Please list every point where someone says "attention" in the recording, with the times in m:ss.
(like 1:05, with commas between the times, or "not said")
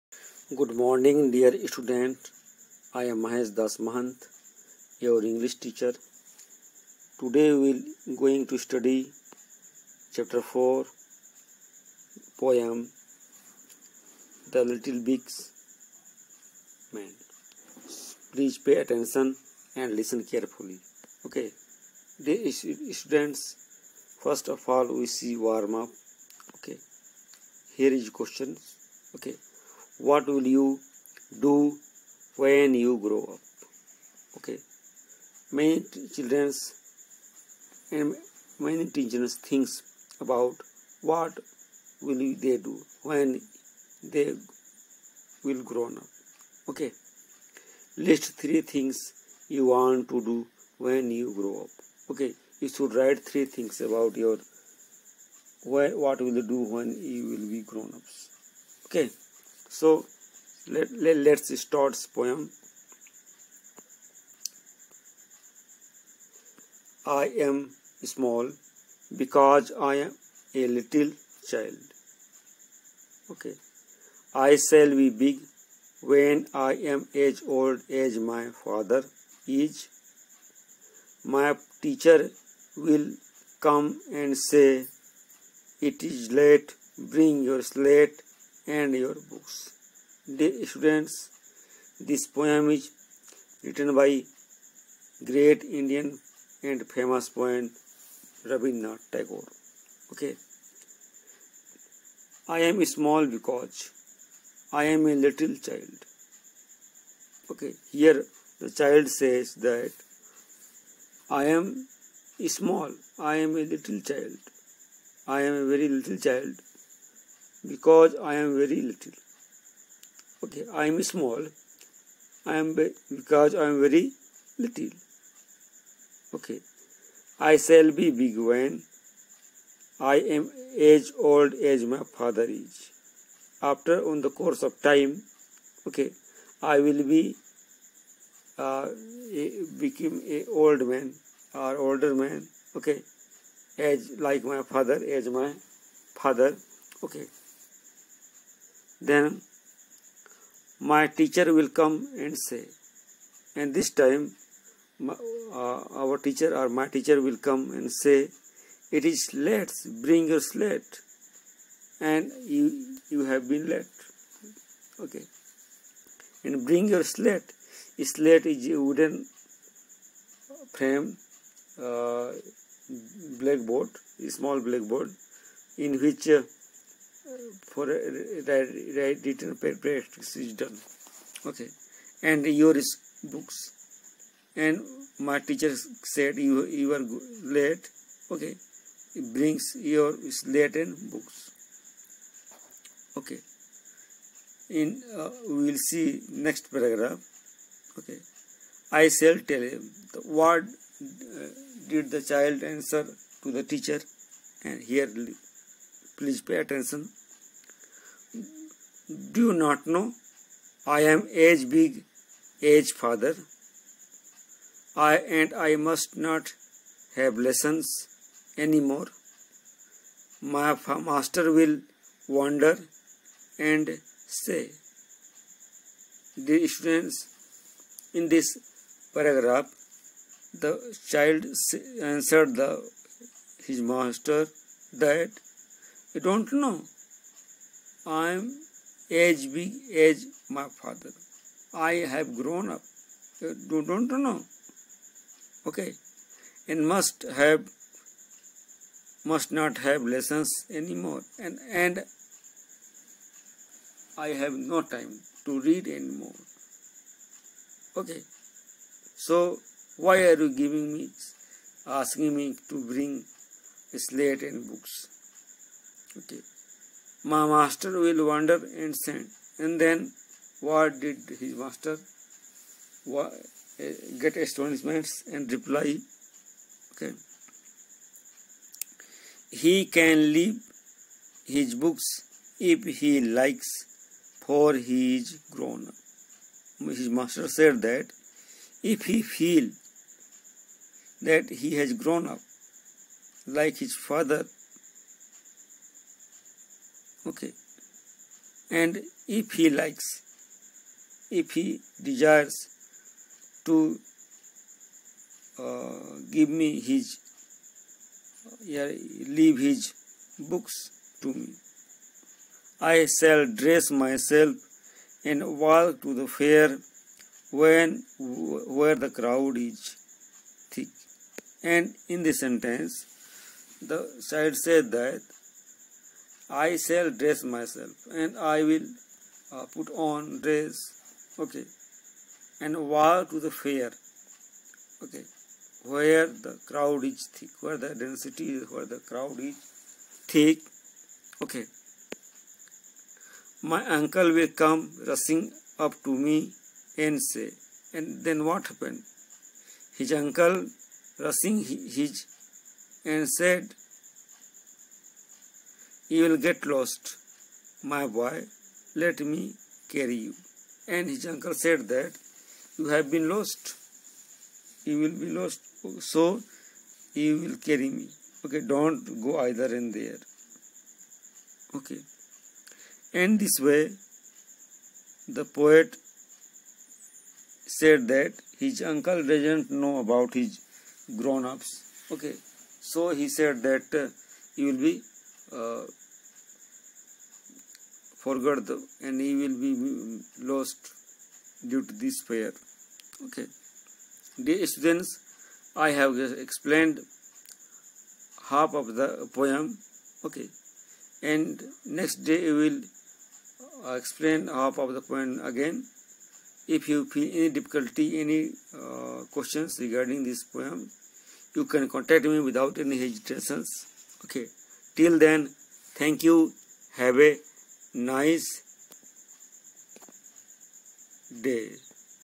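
0:18, 3:26.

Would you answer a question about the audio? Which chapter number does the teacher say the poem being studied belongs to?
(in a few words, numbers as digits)
4.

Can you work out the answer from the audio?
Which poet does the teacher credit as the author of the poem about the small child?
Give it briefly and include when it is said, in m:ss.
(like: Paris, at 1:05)
Rabindranath Tagore, at 1:38.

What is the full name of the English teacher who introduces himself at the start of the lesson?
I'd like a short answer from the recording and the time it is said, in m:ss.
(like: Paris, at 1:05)
Mahesh Das Mahant, at 0:03.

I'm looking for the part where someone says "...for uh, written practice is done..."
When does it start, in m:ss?
2:57.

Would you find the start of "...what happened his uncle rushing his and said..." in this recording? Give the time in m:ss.
5:48.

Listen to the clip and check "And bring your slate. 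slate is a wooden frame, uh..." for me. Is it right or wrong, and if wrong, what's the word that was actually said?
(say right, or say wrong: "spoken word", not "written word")
right.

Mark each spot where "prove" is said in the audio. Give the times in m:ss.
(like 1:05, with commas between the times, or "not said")
not said.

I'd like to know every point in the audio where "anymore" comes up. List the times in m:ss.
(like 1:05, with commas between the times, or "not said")
3:38, 4:10, 4:15.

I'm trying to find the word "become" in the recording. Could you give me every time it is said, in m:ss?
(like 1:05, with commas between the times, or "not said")
2:19.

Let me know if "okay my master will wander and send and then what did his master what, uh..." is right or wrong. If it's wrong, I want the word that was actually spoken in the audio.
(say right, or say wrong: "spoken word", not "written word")
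right.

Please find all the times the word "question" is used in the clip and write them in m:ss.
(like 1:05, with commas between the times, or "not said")
0:28, 6:49.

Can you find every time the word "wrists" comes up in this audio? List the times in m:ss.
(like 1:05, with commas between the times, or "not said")
not said.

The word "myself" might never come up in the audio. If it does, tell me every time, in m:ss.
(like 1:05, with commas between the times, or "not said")
5:13, 5:27.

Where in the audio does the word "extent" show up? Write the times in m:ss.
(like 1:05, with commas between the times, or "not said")
not said.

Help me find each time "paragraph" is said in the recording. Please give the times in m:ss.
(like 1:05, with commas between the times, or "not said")
3:16, 3:49.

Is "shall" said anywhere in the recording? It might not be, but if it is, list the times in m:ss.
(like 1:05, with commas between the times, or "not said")
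1:14, 2:07, 3:19, 5:13, 5:26.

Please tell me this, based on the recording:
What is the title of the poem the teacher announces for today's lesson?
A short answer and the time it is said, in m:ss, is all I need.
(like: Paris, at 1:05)
The Little Big Man, at 0:14.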